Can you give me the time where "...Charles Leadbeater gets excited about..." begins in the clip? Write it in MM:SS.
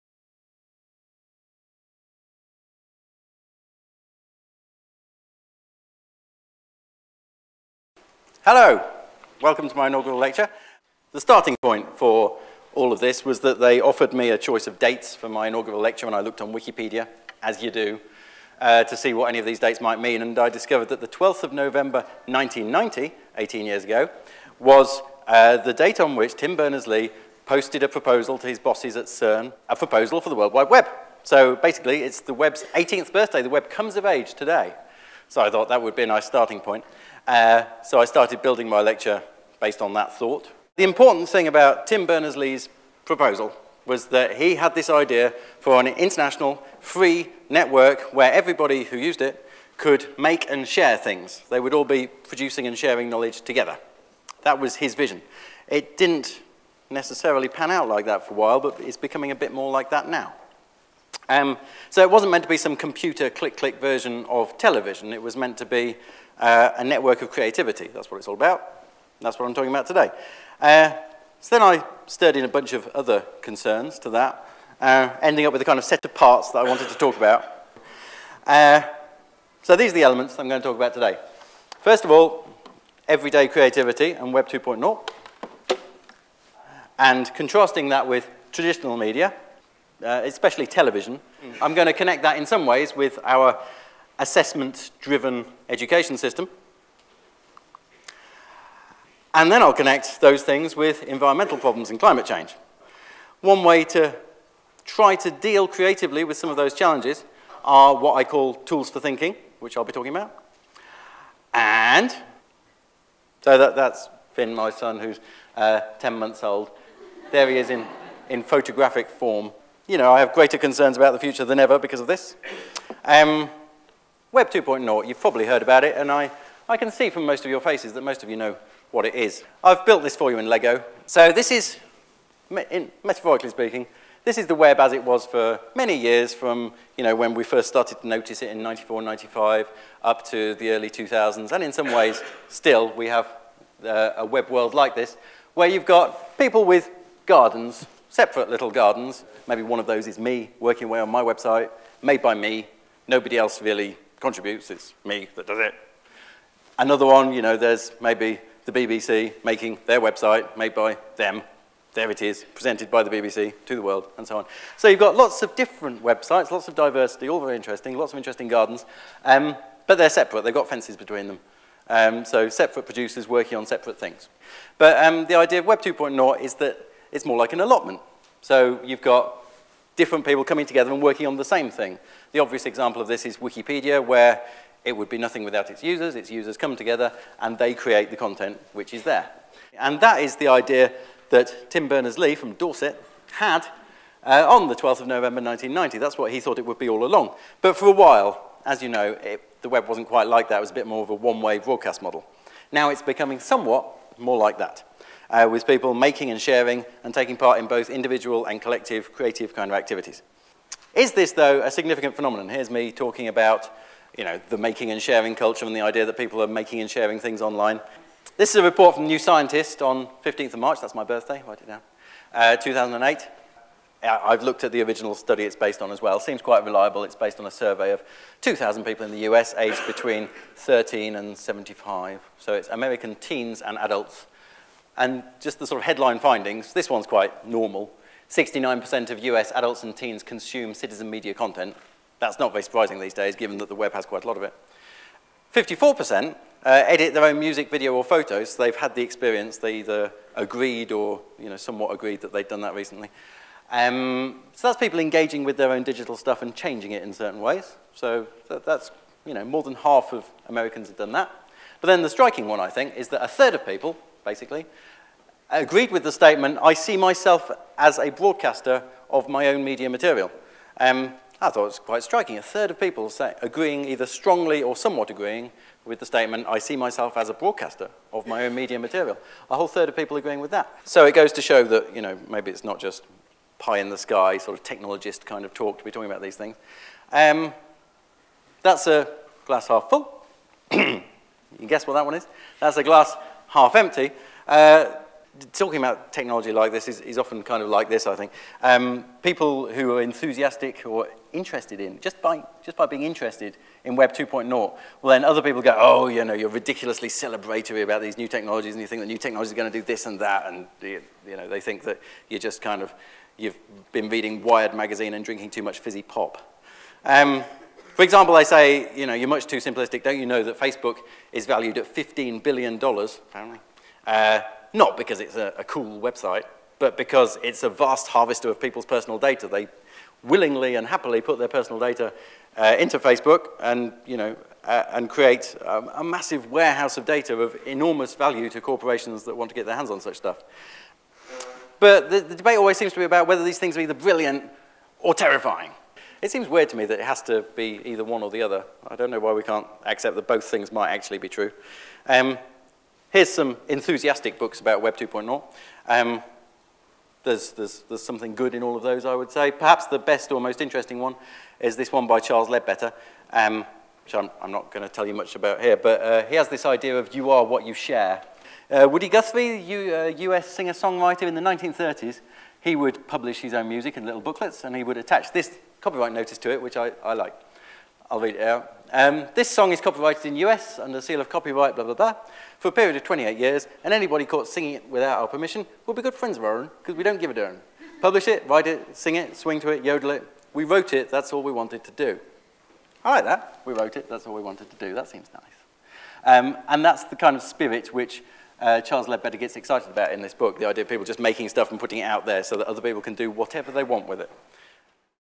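06:38.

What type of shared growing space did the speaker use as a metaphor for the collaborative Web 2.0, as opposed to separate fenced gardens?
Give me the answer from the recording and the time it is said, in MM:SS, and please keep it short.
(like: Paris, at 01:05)
An allotment, at 02:57.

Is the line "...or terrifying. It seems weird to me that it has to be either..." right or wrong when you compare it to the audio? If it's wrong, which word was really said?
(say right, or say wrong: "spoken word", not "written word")
right.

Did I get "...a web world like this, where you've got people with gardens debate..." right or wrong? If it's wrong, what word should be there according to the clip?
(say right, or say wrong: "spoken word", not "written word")
wrong: "separate", not "debate".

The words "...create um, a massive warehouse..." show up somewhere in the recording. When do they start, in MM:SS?
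05:35.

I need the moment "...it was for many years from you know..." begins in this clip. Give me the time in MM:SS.
02:14.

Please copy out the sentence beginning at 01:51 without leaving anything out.
And so that, that's Finn, my son, who's uh, 10 months old.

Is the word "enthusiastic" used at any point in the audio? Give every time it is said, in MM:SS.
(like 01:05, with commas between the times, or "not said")
05:00, 05:53.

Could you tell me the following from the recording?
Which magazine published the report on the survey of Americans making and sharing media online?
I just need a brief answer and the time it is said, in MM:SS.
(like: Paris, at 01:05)
New Scientist, at 03:39.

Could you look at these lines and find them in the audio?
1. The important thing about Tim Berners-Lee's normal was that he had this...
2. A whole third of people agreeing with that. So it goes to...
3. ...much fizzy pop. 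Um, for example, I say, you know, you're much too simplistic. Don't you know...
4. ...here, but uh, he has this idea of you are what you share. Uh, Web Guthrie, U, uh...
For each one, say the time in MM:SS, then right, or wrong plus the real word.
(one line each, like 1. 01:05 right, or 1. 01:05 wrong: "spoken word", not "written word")
1. 00:40 wrong: "proposal", not "normal"
2. 04:39 right
3. 05:15 right
4. 06:05 wrong: "Woody", not "Web".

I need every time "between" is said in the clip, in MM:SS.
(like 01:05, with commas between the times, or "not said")
02:50, 03:49.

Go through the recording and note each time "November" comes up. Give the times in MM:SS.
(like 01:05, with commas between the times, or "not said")
00:21, 03:15.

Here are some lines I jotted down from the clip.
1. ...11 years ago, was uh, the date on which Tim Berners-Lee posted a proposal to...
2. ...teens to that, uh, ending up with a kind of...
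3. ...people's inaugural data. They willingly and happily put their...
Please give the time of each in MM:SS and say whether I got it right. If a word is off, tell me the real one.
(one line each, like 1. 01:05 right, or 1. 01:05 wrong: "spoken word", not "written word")
1. 00:23 wrong: "18", not "11"
2. 01:13 wrong: "concerns", not "teens"
3. 05:28 wrong: "personal", not "inaugural".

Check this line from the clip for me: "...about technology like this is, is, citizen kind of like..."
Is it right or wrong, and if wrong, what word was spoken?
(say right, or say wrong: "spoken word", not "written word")
wrong: "often", not "citizen".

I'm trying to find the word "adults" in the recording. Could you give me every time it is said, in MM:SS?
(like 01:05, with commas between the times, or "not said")
03:53, 03:59.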